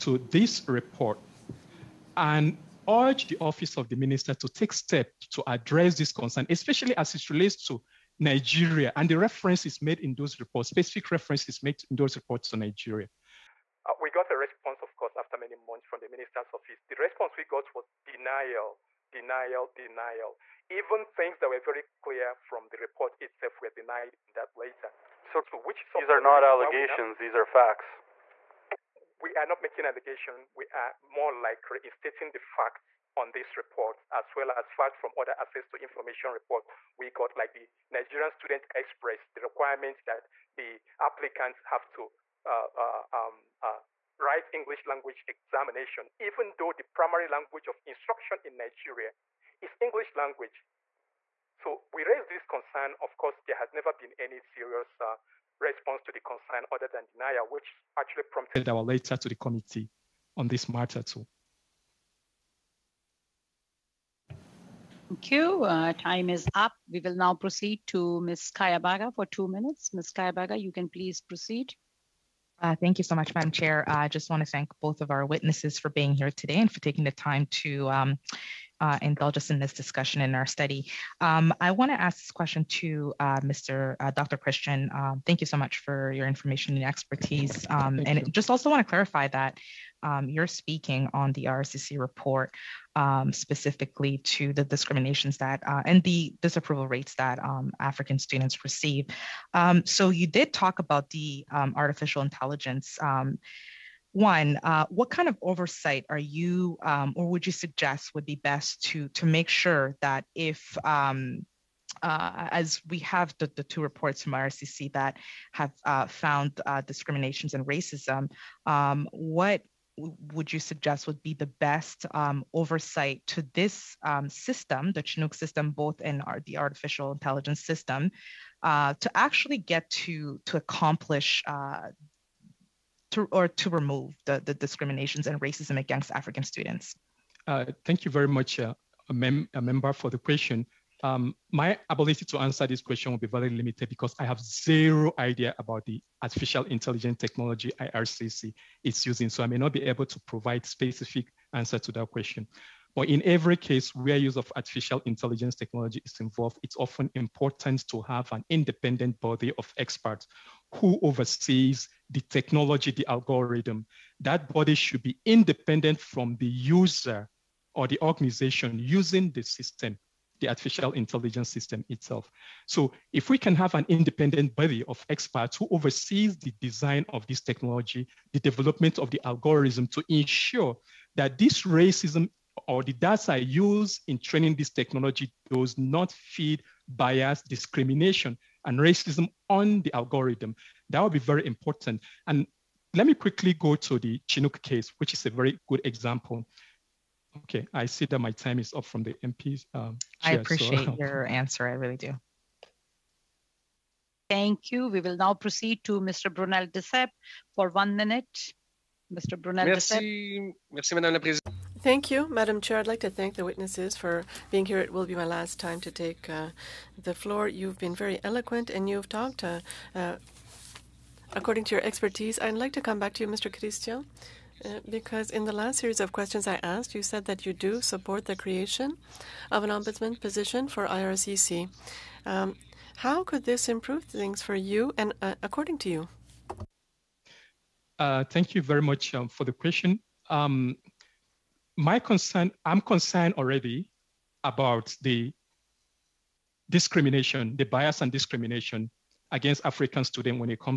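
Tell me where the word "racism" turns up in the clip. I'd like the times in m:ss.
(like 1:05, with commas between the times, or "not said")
1:57, 2:15, 3:01, 3:08.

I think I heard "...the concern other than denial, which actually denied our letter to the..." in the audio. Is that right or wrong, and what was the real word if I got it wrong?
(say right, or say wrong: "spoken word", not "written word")
wrong: "prompted", not "denied".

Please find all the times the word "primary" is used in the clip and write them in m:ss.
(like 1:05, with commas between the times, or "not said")
0:46.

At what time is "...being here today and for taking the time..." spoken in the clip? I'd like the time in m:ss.
1:15.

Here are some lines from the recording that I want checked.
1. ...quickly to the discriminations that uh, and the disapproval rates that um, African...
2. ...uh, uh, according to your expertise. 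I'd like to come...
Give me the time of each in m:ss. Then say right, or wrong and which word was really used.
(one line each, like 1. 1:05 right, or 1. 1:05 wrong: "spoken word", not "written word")
1. 1:33 wrong: "specifically", not "quickly"
2. 3:39 right.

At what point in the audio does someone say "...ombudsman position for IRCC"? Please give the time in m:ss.
3:49.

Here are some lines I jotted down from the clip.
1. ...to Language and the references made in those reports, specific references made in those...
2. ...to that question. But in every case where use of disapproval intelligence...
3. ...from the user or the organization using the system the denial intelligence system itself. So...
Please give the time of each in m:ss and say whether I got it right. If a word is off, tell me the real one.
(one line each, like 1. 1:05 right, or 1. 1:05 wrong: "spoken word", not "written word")
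1. 0:07 wrong: "Nigeria", not "Language"
2. 2:31 wrong: "artificial", not "disapproval"
3. 2:45 wrong: "artificial", not "denial".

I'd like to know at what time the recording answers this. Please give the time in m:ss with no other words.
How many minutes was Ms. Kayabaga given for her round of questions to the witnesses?
1:09.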